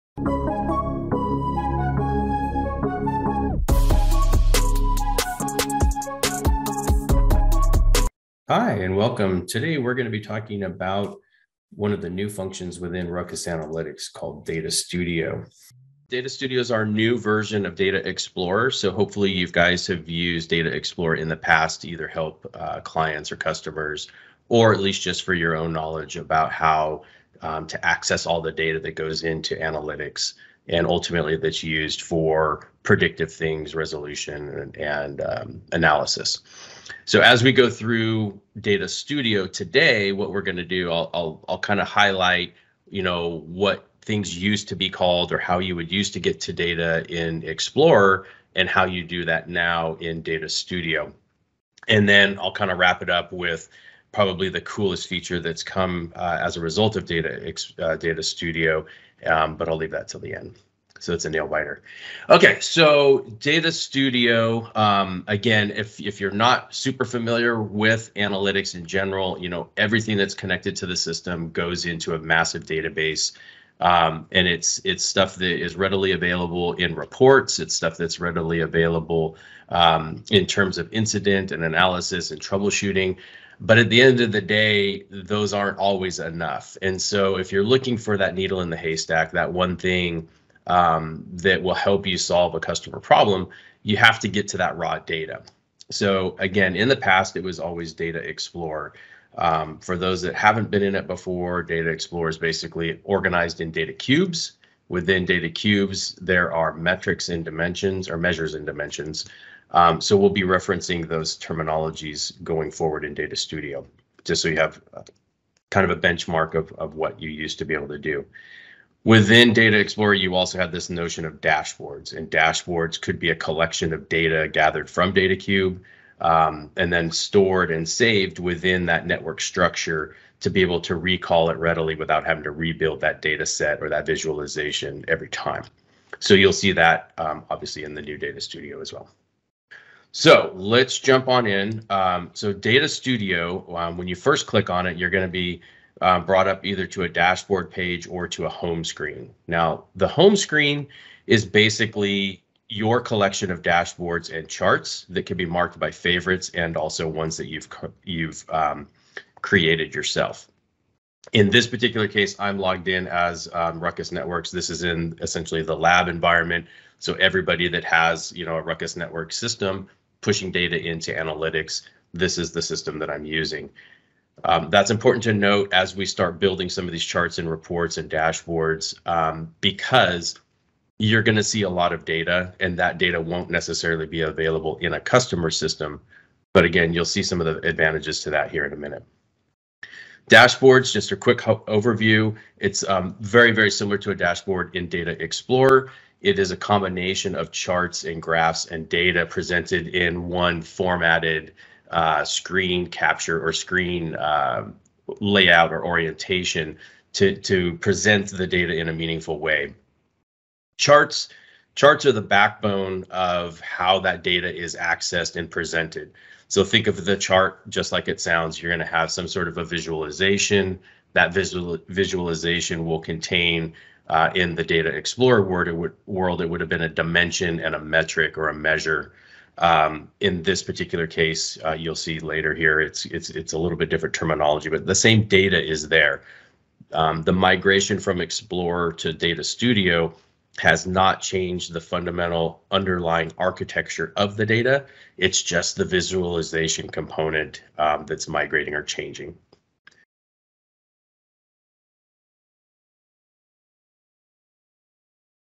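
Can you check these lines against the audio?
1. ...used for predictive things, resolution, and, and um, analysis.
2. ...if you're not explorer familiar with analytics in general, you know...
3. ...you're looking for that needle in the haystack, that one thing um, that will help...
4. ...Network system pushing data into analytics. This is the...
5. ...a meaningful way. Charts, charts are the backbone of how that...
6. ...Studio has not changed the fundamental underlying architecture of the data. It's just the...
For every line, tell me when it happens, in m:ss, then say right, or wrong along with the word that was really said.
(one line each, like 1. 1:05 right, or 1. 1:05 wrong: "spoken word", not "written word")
1. 0:31 right
2. 1:05 wrong: "super", not "explorer"
3. 1:27 right
4. 2:48 right
5. 3:28 right
6. 3:59 right.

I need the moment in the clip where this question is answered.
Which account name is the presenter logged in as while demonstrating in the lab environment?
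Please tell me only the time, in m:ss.
2:43.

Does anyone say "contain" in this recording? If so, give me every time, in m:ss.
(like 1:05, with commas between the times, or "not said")
3:42.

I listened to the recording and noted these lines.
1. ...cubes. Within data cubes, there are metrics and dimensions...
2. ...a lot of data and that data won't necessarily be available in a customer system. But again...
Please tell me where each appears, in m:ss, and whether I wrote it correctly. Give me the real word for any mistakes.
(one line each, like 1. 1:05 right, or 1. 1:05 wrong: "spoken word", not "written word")
1. 1:43 right
2. 3:01 right.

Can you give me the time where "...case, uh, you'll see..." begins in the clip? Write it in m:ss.
3:51.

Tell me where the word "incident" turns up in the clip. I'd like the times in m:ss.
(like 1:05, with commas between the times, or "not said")
1:20.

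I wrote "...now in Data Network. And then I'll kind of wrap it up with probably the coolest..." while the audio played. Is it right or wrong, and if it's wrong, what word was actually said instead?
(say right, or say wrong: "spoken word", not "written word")
wrong: "Studio", not "Network".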